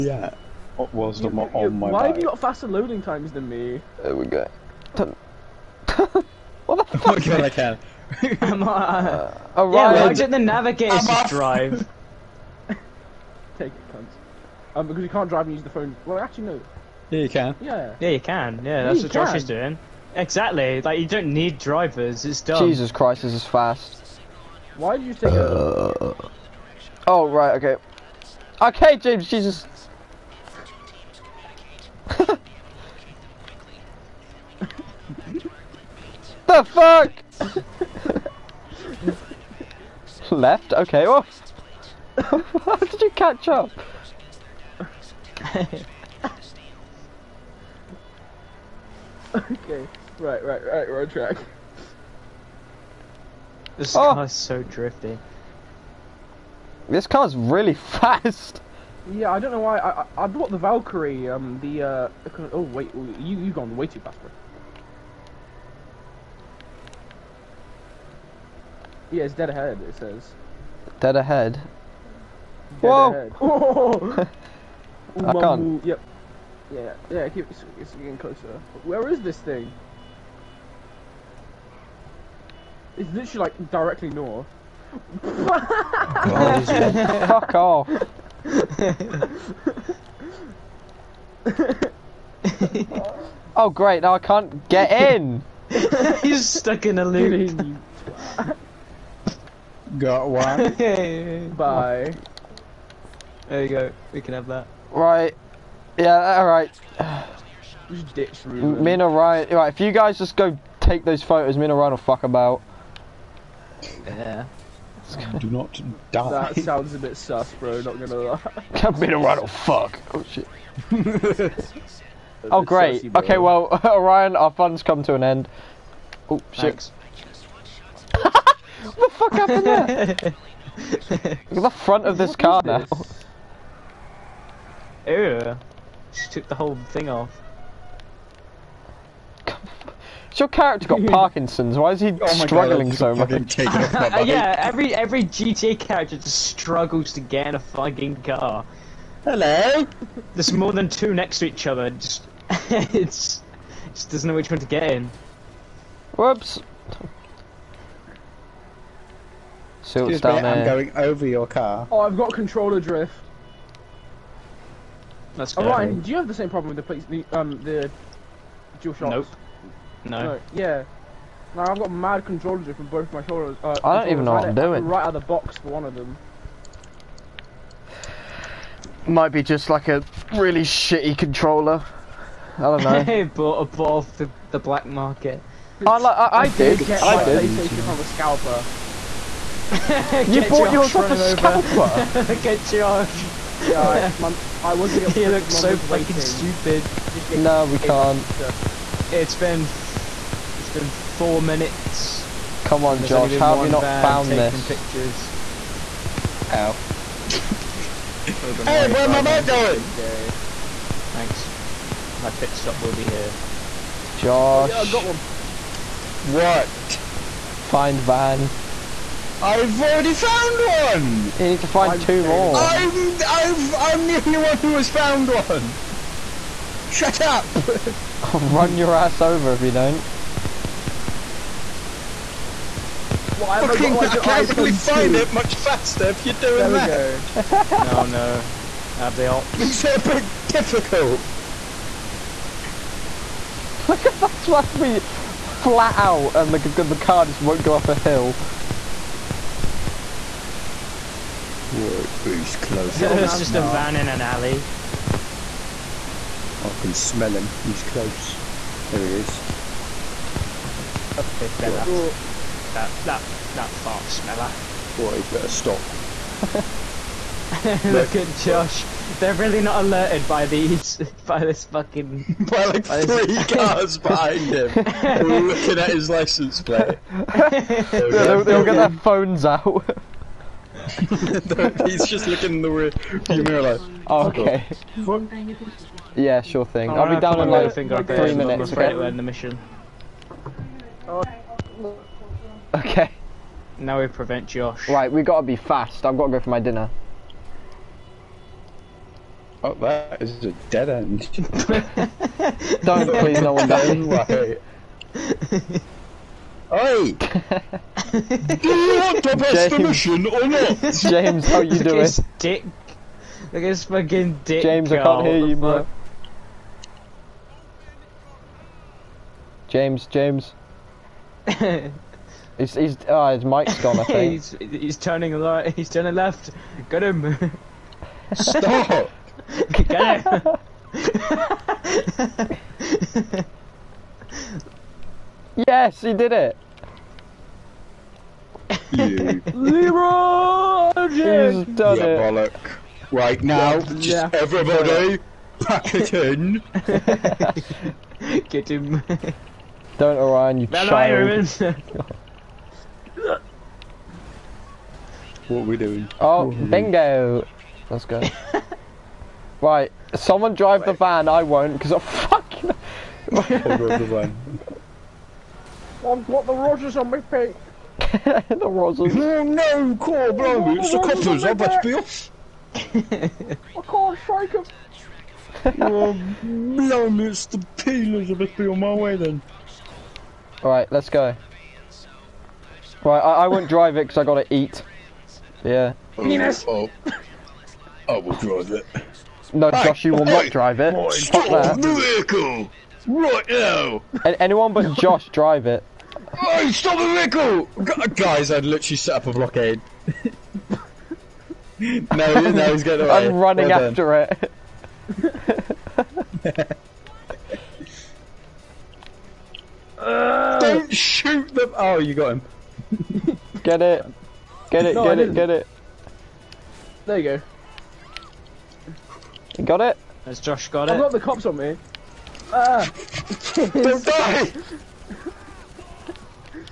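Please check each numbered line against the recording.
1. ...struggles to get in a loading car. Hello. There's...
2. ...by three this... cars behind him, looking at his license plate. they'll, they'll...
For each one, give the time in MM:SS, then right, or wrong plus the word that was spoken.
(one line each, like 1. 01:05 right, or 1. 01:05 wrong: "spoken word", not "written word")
1. 02:26 wrong: "fucking", not "loading"
2. 04:32 right.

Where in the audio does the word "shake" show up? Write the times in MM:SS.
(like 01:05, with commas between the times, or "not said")
06:14.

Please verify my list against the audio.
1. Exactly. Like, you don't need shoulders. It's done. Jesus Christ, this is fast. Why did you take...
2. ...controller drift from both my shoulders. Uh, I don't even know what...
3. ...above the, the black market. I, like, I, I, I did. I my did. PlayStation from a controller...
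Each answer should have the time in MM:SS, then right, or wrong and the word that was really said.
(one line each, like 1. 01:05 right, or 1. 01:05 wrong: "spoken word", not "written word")
1. 00:20 wrong: "drivers", not "shoulders"
2. 02:52 right
3. 03:03 wrong: "scalper", not "controller".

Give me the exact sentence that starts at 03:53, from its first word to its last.
Why am Fucking, I, can't really find it much faster if you're doing there that.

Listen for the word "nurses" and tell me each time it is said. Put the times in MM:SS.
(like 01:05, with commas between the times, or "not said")
not said.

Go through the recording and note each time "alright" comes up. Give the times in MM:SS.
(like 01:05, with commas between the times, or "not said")
01:46, 06:20.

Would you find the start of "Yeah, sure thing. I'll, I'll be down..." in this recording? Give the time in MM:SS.
04:46.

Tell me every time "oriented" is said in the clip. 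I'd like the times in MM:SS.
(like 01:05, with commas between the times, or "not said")
not said.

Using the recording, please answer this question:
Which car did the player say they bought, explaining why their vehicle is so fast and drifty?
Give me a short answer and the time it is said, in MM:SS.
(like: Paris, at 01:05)
Valkyrie, at 01:00.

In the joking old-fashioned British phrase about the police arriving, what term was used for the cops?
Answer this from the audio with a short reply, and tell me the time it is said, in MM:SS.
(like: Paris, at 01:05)
Peelers, at 06:17.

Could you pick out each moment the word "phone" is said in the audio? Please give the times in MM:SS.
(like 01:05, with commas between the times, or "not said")
00:15, 04:39.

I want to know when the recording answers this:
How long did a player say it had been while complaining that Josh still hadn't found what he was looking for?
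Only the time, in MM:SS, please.
03:20.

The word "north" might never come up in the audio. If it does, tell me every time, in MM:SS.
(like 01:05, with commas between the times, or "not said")
01:24.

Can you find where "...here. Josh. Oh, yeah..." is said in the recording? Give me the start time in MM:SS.
03:33.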